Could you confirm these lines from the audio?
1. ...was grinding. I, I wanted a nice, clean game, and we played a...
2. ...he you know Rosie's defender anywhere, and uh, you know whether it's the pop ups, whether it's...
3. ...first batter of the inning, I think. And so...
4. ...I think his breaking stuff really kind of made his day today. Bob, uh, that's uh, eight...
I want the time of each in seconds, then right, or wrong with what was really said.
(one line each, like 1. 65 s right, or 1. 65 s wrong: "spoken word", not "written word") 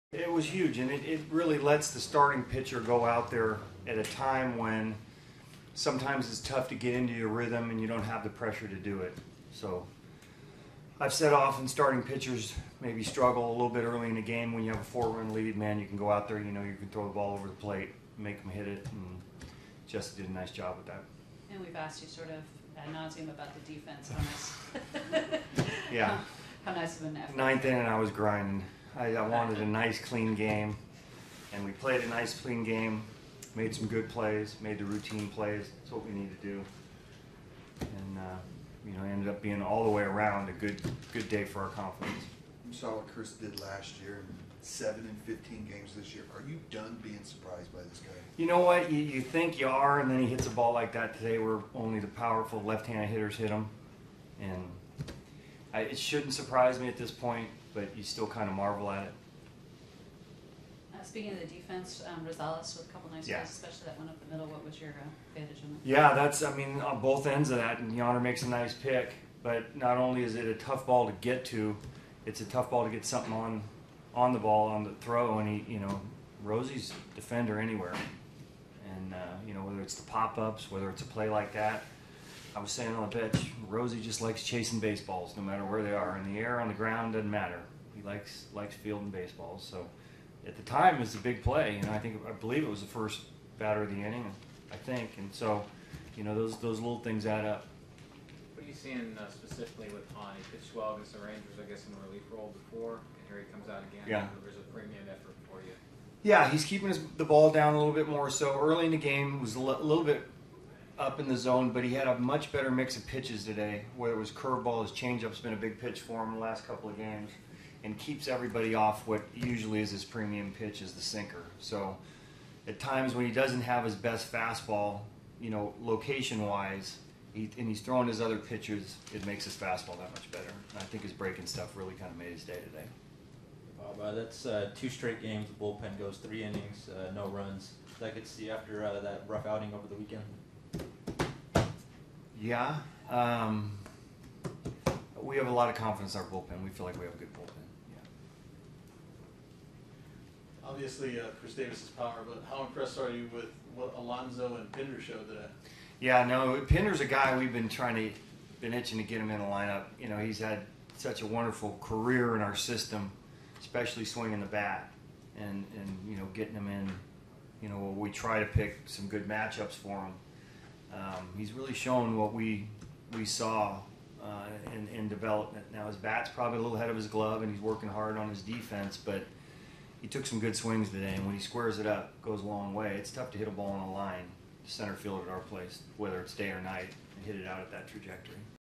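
1. 27 s right
2. 75 s right
3. 92 s right
4. 130 s wrong: "two", not "eight".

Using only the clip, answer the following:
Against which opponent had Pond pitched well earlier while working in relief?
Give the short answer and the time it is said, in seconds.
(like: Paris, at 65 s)
Rangers, at 101 s.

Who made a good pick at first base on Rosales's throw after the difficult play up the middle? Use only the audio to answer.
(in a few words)
Yonder.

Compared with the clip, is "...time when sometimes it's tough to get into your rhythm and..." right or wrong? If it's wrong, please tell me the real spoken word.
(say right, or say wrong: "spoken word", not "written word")
right.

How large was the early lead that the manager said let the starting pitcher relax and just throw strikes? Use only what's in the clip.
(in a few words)
4 runs.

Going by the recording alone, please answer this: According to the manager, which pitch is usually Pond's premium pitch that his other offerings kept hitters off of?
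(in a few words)
Sinker.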